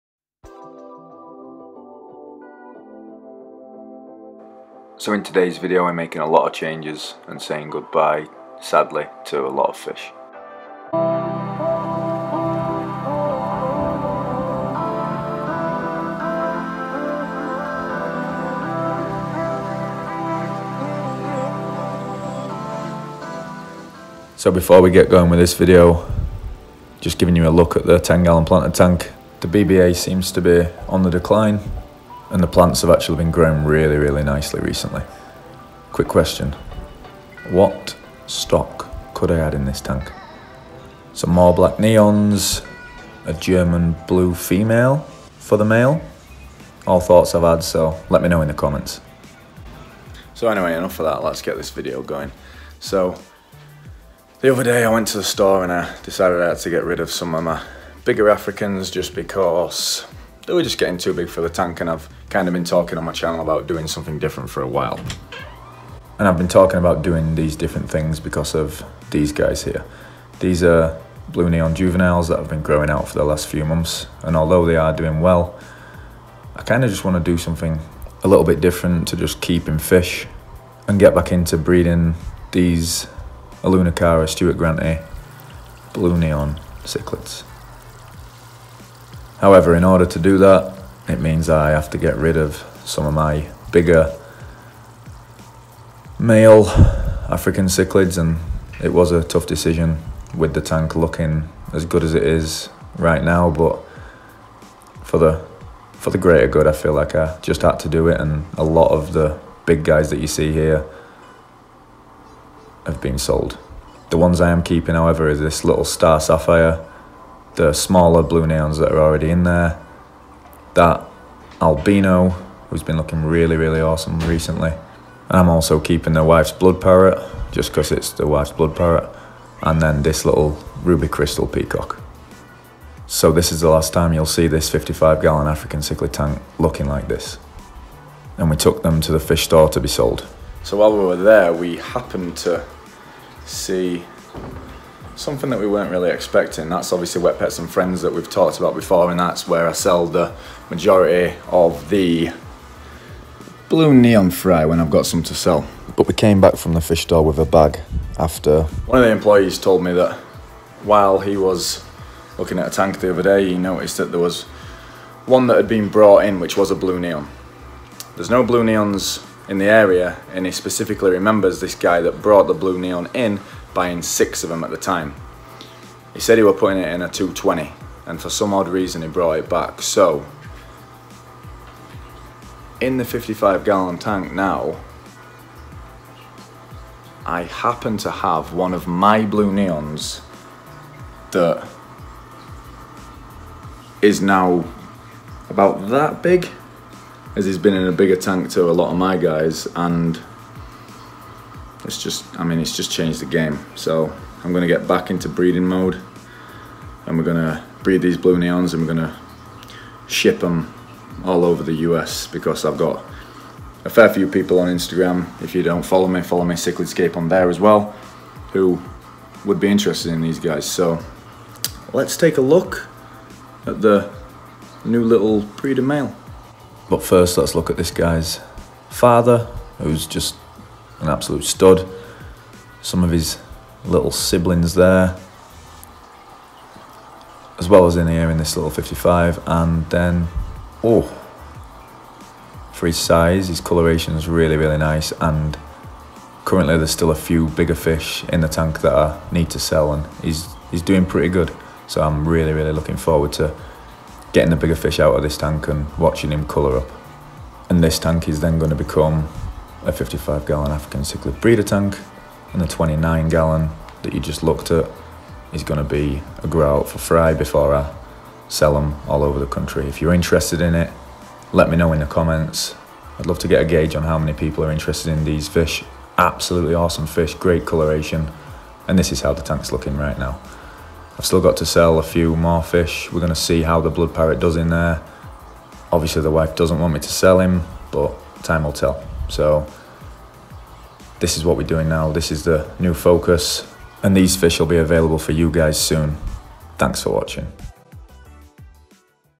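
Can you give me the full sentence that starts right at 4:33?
I'd love to get a gauge on how many people are interested in these fish.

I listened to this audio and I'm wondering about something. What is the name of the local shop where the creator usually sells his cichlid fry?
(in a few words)
Wet Pets and Friends.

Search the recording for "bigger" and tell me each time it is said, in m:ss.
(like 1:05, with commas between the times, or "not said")
0:58, 1:33, 3:17, 4:07, 4:14.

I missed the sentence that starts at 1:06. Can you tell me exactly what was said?
And I've been talking about doing these different things because of these guys here.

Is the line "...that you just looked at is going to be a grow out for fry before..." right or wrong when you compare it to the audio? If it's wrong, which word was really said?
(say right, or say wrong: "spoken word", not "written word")
right.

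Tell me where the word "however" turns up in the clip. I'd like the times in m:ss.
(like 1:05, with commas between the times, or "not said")
1:29, 1:54.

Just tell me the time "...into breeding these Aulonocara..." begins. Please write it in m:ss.
1:21.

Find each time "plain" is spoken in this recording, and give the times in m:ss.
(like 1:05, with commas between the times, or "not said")
not said.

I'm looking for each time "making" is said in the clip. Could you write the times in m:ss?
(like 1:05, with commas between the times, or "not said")
0:05.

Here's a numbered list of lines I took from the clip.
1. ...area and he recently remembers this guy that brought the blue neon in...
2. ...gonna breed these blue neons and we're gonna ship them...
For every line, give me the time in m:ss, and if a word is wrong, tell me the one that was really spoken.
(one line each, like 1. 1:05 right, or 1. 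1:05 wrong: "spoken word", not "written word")
1. 2:49 wrong: "specifically", not "recently"
2. 3:27 right.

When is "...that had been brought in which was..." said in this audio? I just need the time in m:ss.
2:45.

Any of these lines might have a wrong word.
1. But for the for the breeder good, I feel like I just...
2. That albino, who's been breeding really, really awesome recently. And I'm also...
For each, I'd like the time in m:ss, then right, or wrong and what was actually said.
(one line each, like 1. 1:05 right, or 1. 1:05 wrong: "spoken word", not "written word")
1. 1:43 wrong: "greater", not "breeder"
2. 2:00 wrong: "looking", not "breeding".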